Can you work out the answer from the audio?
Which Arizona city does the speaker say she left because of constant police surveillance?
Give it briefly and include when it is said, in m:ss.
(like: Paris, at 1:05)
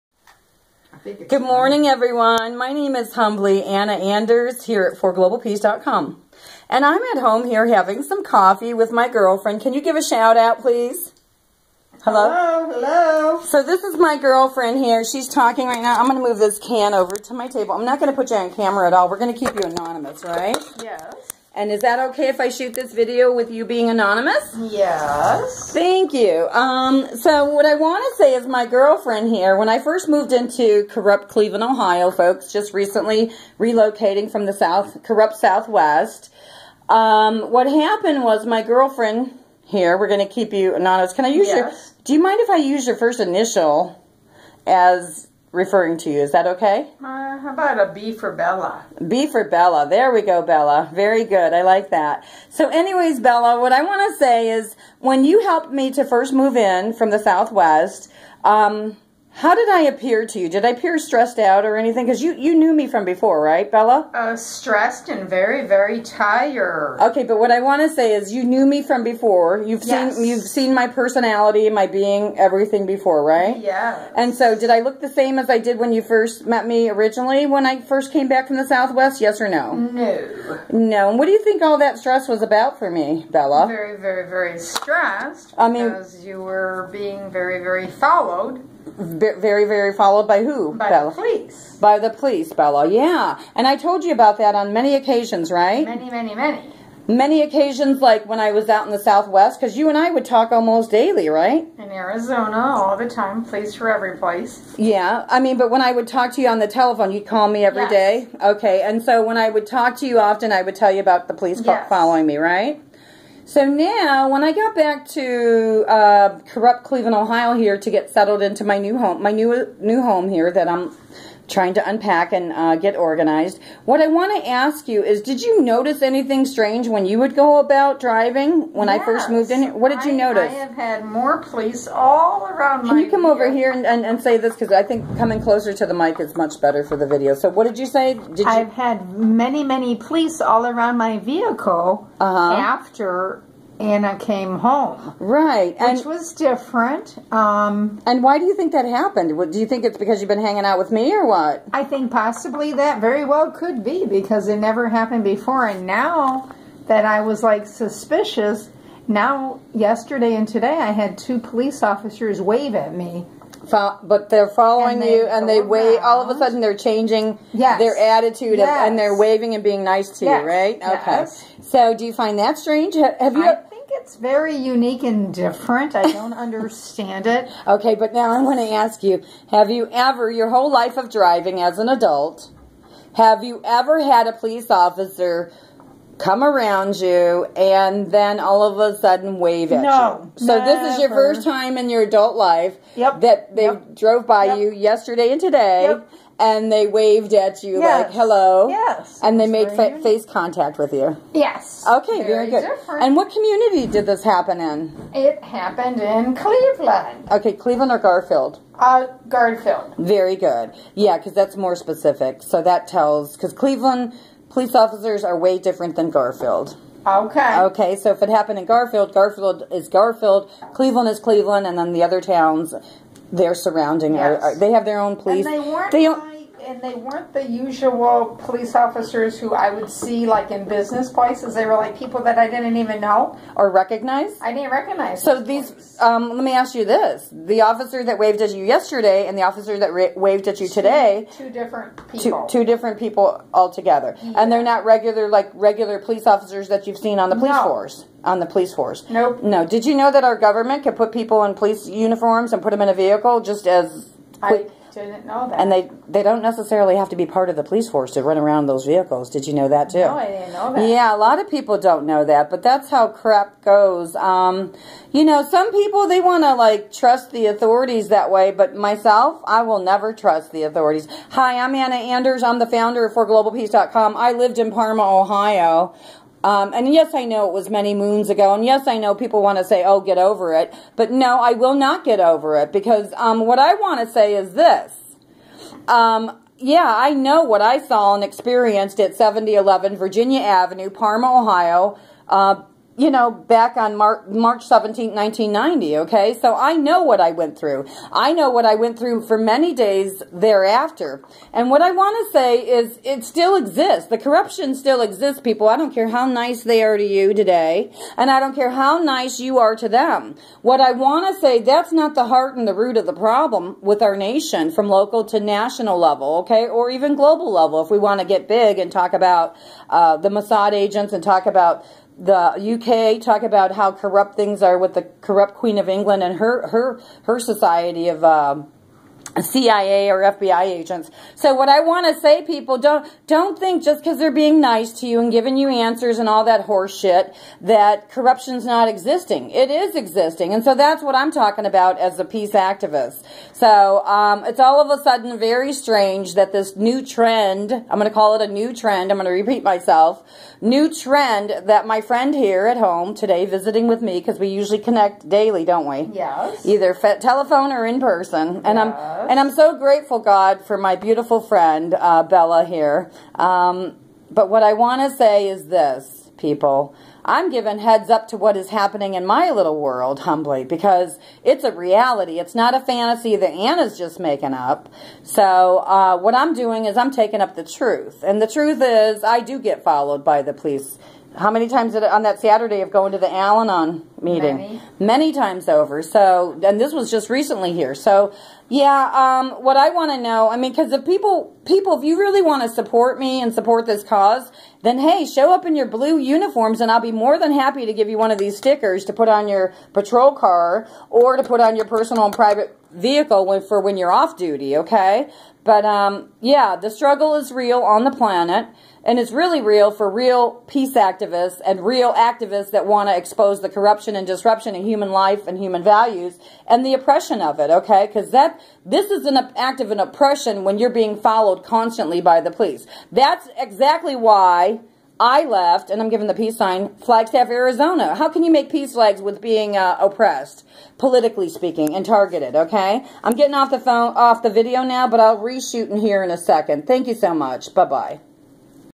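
Flagstaff, at 7:06.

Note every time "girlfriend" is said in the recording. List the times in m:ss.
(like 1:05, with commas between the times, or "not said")
0:09, 0:14, 0:28, 0:38.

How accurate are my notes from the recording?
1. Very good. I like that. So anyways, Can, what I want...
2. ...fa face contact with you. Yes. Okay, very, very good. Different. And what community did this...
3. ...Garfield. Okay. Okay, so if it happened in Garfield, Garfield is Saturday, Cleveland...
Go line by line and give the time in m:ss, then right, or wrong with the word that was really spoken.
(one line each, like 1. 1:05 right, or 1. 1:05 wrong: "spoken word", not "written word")
1. 0:50 wrong: "Bella", not "Can"
2. 3:19 right
3. 3:36 wrong: "Garfield", not "Saturday".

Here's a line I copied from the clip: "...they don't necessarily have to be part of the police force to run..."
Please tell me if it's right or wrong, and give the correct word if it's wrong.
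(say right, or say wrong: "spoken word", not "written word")
right.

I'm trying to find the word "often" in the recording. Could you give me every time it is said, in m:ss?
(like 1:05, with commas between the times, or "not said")
1:50.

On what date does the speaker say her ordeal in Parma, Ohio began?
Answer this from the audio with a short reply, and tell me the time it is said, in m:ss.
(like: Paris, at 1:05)
March 17, 1990, at 4:54.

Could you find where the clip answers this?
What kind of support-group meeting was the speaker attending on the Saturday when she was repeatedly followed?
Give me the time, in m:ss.
6:23.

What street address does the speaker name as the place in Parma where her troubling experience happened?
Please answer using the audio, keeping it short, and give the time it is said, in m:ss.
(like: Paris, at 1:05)
7011 Virginia Avenue, at 4:49.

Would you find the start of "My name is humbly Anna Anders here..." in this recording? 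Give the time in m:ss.
0:02.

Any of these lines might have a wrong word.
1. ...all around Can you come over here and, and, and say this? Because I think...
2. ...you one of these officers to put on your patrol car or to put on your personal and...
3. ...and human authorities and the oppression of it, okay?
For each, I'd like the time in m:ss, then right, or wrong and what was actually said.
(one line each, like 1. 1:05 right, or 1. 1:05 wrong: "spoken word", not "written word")
1. 2:11 right
2. 6:38 wrong: "stickers", not "officers"
3. 6:55 wrong: "values", not "authorities".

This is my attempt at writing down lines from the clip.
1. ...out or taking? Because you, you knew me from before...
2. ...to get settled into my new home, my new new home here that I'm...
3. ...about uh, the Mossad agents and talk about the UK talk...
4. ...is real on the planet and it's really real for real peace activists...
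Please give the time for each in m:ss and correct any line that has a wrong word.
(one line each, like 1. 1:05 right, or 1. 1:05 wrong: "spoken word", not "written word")
1. 1:01 wrong: "anything", not "taking"
2. 1:57 right
3. 5:19 right
4. 6:47 right.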